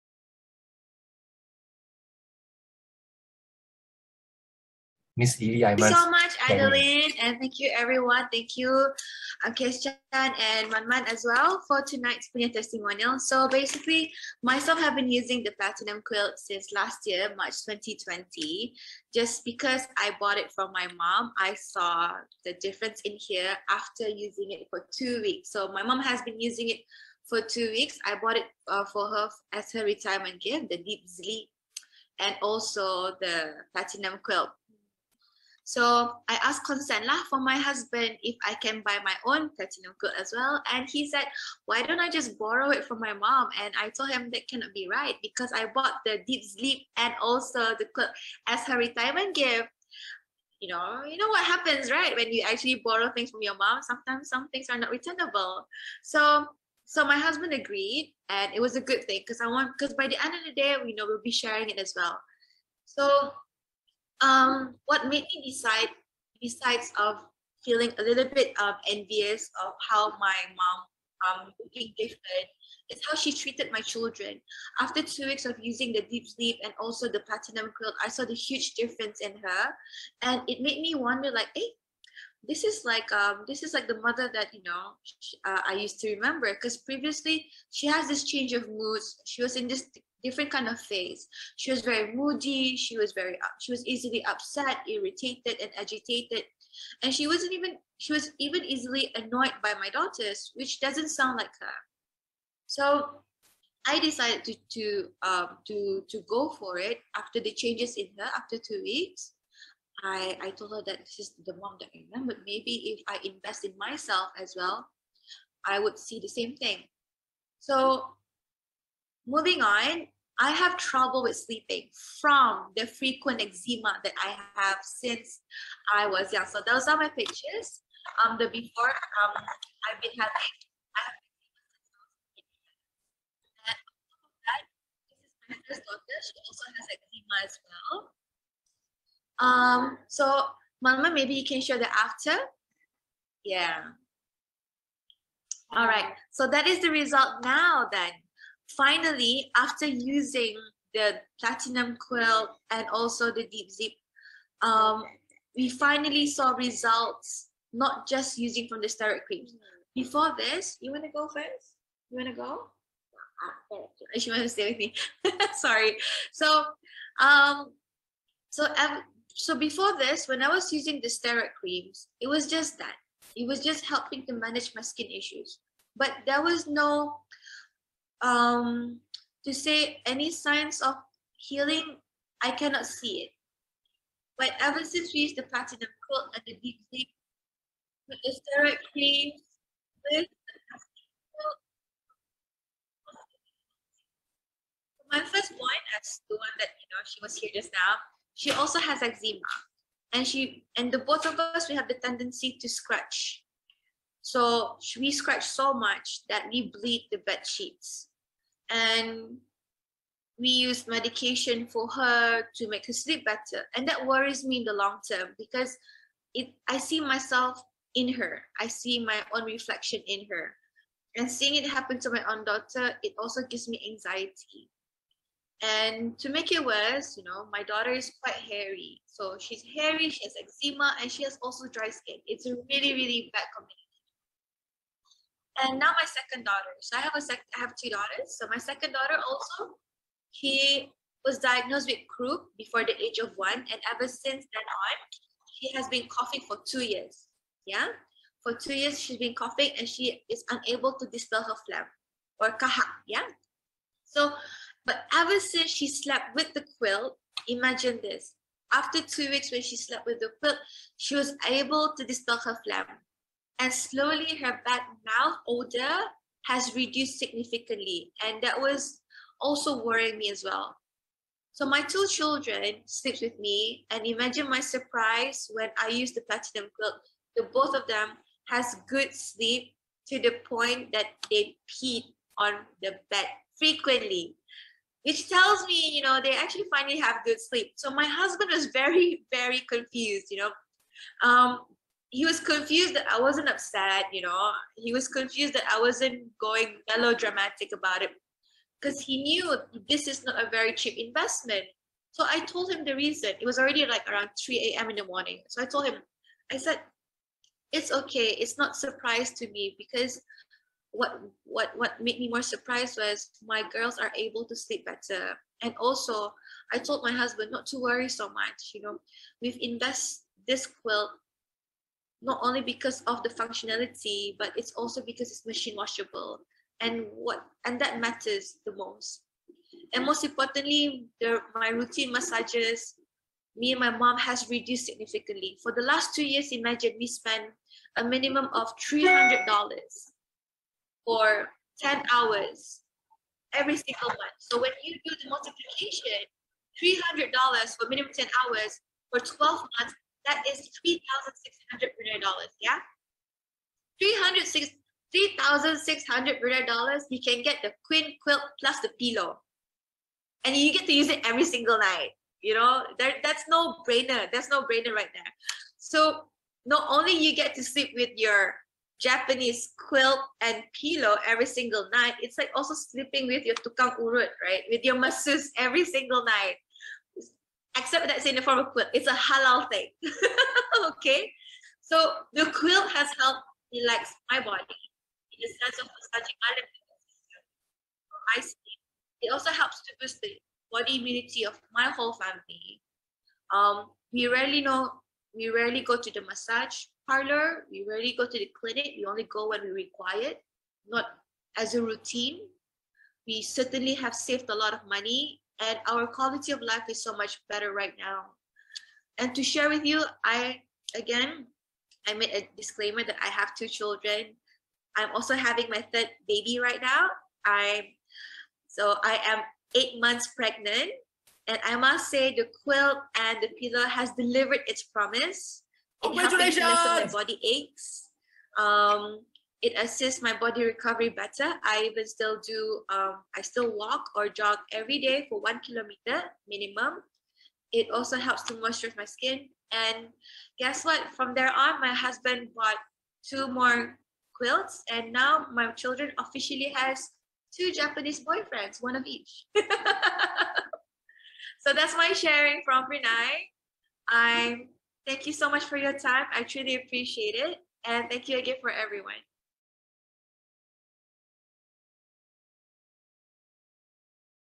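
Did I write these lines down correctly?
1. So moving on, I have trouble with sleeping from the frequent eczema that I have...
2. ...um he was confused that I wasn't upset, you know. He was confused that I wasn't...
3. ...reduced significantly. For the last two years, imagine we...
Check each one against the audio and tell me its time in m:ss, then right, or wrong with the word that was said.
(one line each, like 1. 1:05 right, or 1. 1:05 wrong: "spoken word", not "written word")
1. 1:57 right
2. 4:51 right
3. 5:34 right.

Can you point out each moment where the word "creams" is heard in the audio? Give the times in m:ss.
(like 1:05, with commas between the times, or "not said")
2:39, 2:51, 3:08.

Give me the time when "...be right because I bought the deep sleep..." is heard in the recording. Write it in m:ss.
0:44.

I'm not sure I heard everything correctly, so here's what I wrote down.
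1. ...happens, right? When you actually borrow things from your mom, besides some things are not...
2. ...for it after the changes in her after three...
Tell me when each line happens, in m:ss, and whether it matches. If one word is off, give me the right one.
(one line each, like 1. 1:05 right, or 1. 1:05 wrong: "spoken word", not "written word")
1. 0:51 wrong: "sometimes", not "besides"
2. 1:46 wrong: "two", not "three".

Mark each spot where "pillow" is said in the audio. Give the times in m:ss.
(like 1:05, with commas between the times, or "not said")
5:59, 6:10, 7:03.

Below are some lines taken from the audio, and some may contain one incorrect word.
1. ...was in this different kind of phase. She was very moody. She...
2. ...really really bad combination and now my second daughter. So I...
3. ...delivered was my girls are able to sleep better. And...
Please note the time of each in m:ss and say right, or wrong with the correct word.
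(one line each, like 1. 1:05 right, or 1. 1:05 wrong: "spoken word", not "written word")
1. 1:29 right
2. 3:52 right
3. 5:12 wrong: "surprised", not "delivered".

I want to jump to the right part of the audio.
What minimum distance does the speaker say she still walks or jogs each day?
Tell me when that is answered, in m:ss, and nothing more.
7:15.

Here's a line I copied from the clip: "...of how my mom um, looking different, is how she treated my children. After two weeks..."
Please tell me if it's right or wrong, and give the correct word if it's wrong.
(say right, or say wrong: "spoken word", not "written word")
right.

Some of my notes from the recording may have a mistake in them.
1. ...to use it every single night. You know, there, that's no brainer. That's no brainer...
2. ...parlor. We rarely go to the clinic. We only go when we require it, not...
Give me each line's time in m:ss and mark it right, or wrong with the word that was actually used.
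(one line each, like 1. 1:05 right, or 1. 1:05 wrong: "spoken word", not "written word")
1. 6:00 right
2. 6:37 right.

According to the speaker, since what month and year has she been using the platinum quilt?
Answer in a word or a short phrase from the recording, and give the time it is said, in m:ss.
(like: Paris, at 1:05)
March 2020, at 0:17.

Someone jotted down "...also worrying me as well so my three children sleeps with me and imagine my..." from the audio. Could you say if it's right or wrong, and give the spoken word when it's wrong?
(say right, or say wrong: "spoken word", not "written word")
wrong: "two", not "three".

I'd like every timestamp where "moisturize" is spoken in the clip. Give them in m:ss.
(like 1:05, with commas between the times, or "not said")
7:18.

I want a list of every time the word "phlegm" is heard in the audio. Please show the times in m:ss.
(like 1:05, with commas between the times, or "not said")
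4:11, 4:22.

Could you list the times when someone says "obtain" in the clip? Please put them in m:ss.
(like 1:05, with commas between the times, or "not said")
not said.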